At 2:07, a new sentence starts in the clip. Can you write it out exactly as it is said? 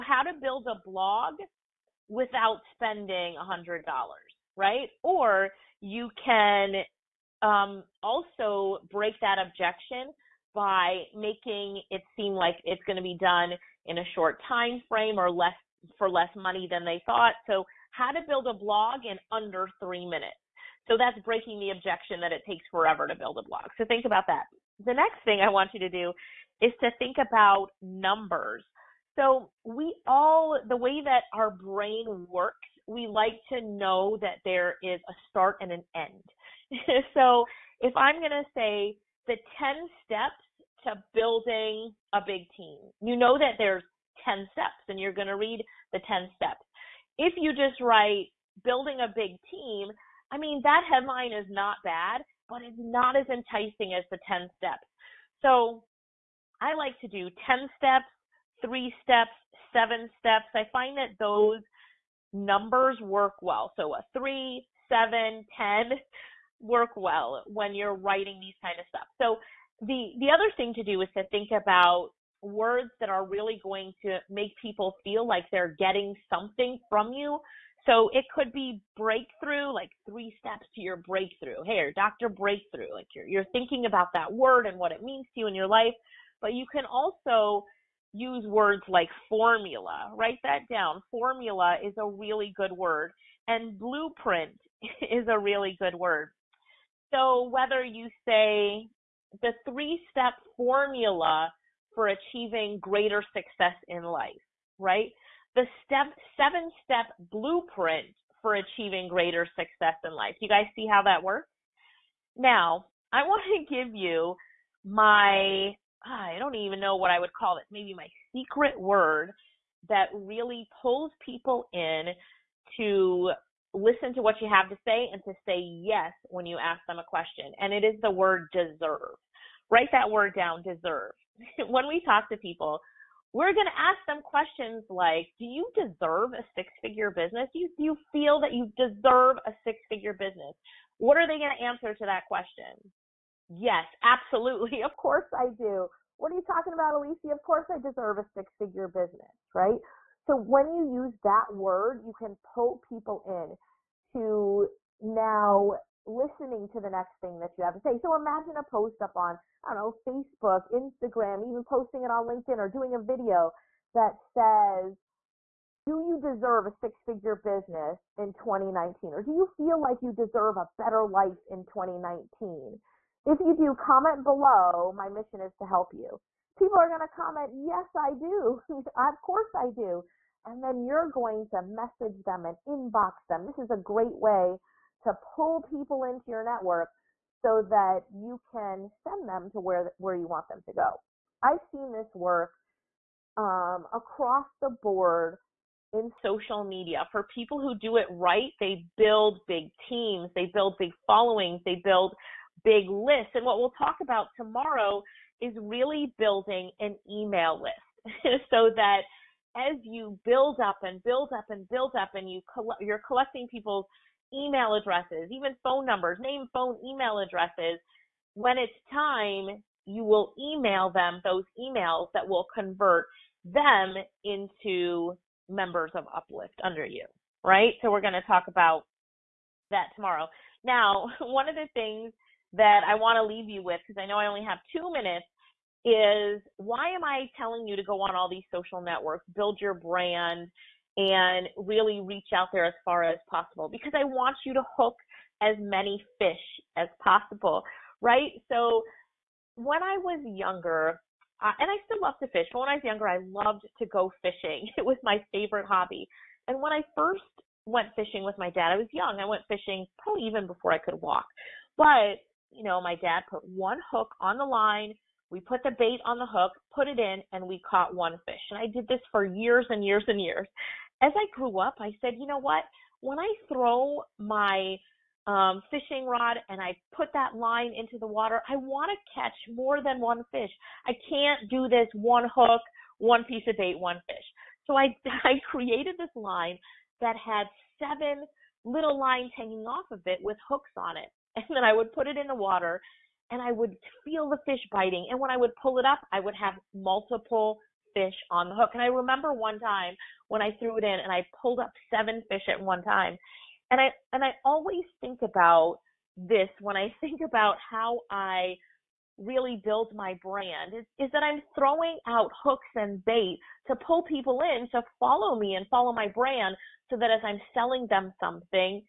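And it is the word deserve write that word down, deserve.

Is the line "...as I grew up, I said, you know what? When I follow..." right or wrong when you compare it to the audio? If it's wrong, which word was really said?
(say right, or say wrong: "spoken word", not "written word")
wrong: "throw", not "follow".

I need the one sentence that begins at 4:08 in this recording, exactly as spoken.
So when I was younger, uh, and I still love to fish, but when I was younger, I loved to go fishing.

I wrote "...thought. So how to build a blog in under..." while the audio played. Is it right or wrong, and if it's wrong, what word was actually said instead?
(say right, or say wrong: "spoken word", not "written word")
right.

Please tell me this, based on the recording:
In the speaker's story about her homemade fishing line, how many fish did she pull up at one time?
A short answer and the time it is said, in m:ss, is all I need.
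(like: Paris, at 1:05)
7, at 5:01.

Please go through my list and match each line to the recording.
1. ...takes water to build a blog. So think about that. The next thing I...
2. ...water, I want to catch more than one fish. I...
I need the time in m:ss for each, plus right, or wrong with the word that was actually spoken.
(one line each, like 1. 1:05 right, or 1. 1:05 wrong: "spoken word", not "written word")
1. 0:22 wrong: "forever", not "water"
2. 4:38 right.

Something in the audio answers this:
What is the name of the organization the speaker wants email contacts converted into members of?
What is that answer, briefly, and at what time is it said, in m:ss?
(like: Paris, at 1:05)
Uplyftt, at 3:46.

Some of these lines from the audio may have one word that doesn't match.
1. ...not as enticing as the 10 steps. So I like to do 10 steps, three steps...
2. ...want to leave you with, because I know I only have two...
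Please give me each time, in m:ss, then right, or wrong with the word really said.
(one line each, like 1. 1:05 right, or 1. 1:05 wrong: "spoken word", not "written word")
1. 0:52 right
2. 3:52 right.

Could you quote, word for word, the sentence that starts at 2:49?
Or do you feel like you deserve a better life in 2019?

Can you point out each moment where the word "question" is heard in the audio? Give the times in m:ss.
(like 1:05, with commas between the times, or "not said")
2:07, 2:14, 2:22.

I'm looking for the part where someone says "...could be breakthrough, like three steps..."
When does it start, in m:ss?
1:18.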